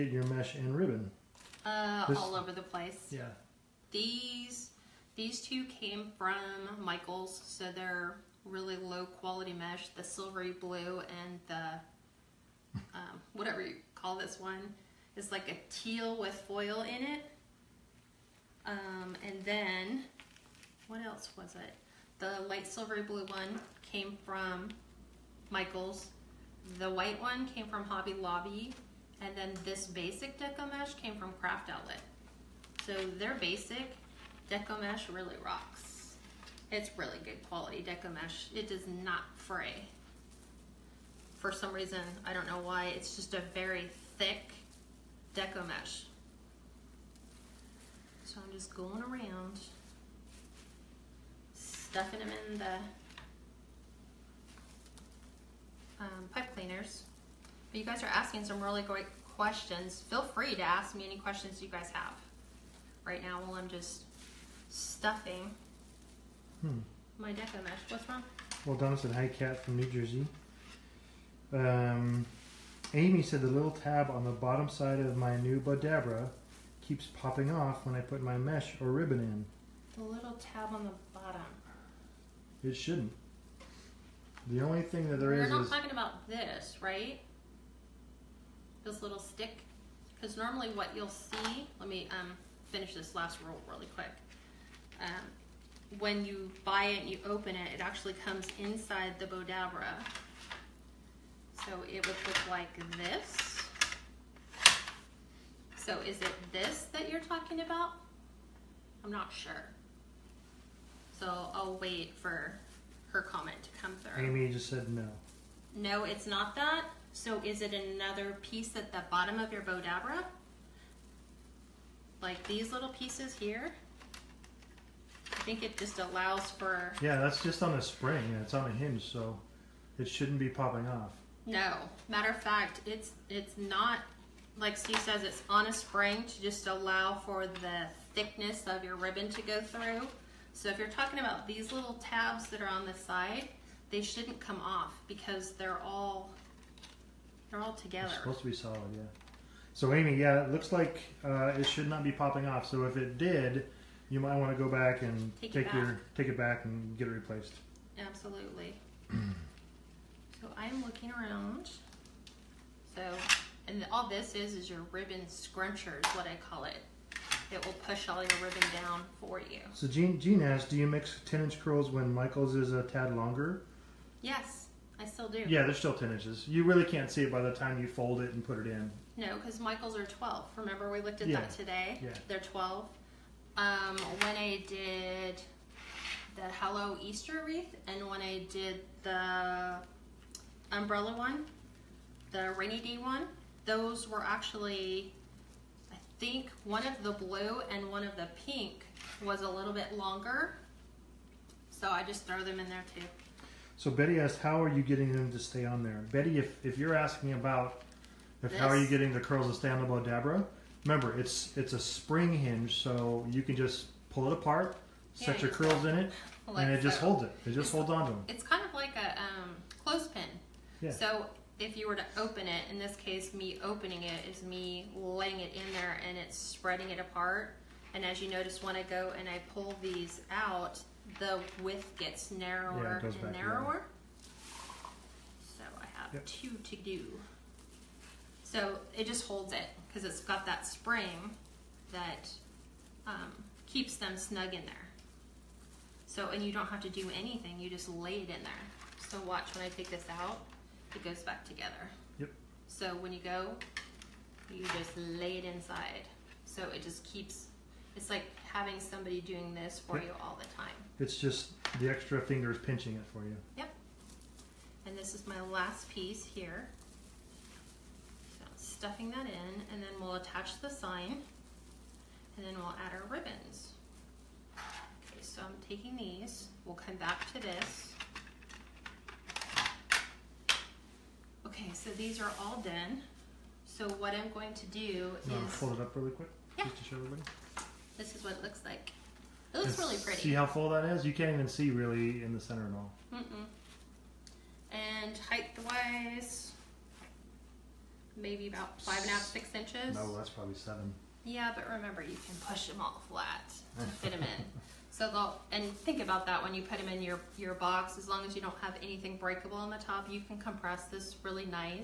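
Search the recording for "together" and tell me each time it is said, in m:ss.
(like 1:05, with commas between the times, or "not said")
2:27, 4:11.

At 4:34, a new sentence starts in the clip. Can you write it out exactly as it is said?
Okay, so I'm taking these, we'll come back to this.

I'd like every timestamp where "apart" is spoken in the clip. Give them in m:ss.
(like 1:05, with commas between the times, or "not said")
3:34, 3:46.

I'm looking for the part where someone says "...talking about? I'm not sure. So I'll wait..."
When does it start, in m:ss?
1:47.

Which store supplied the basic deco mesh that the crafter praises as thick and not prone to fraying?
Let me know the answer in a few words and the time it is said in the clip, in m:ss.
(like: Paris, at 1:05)
Craft Outlet, at 0:31.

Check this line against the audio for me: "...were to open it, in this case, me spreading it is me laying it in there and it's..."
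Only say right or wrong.
wrong.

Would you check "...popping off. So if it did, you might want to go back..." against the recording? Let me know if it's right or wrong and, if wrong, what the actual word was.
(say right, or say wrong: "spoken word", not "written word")
right.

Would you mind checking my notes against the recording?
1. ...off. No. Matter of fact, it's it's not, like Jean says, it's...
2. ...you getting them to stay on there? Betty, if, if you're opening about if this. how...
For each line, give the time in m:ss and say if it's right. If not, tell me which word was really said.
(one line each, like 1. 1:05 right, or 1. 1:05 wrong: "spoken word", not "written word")
1. 2:10 wrong: "Steve", not "Jean"
2. 3:24 wrong: "asking", not "opening".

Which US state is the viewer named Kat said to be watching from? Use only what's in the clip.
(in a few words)
New Jersey.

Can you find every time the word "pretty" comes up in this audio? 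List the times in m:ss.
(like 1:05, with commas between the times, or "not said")
4:50.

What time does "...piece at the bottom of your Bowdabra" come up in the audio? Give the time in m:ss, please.
1:58.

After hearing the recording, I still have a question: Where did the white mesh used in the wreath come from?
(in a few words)
Hobby Lobby.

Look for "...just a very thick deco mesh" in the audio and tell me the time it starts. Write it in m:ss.
0:43.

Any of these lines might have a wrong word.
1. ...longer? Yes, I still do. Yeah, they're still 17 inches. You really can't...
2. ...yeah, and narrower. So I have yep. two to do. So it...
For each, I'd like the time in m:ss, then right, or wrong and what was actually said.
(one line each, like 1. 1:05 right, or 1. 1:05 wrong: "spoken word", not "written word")
1. 2:53 wrong: "10", not "17"
2. 3:53 right.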